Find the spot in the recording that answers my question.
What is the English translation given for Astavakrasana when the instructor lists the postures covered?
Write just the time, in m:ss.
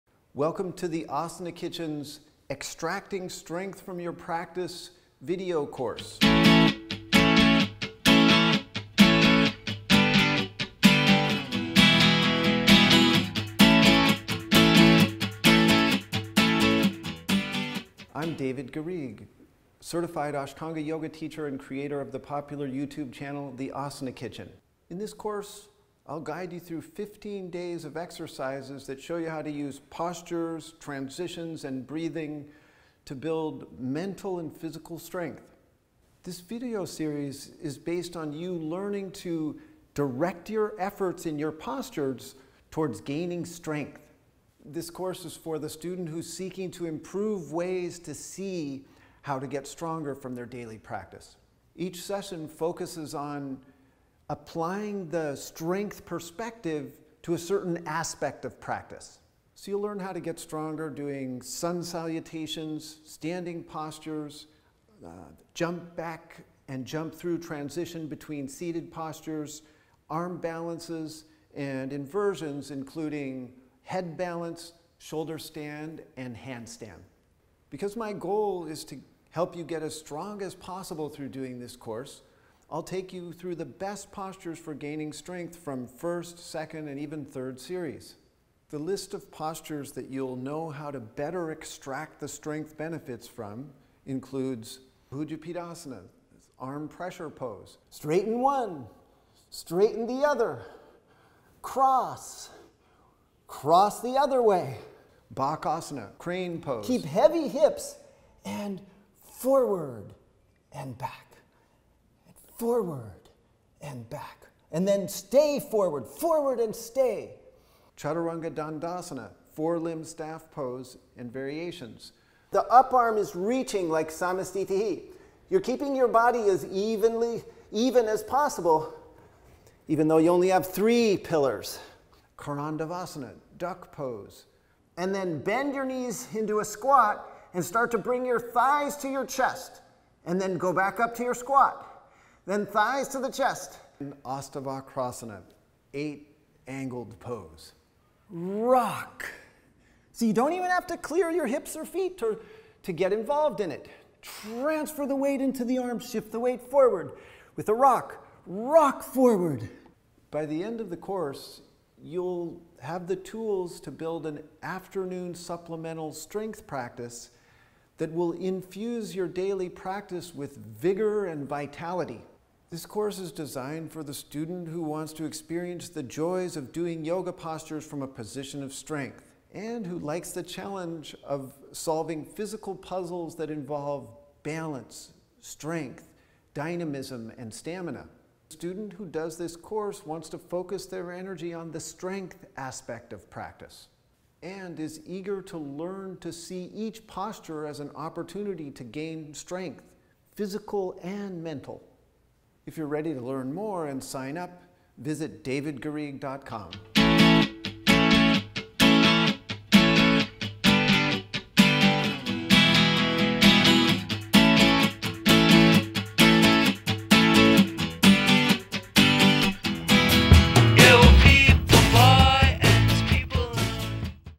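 2:25.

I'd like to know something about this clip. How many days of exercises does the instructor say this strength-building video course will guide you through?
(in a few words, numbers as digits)
15.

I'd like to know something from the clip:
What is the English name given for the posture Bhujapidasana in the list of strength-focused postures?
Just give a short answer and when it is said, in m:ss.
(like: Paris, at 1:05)
arm pressure pose, at 1:36.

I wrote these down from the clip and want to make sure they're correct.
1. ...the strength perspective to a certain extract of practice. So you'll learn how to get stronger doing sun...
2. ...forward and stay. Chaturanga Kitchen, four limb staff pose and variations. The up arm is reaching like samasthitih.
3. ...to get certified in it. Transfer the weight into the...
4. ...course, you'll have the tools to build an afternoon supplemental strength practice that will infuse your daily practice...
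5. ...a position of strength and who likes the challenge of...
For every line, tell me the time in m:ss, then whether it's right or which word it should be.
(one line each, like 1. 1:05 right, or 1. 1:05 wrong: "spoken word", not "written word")
1. 0:55 wrong: "aspect", not "extract"
2. 1:56 wrong: "Dandasana", not "Kitchen"
3. 2:32 wrong: "involved", not "certified"
4. 2:40 right
5. 2:58 right.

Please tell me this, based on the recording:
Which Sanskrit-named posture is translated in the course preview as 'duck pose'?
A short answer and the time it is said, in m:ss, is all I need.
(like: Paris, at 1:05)
Karandavasana, at 2:12.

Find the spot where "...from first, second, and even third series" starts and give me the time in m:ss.
1:25.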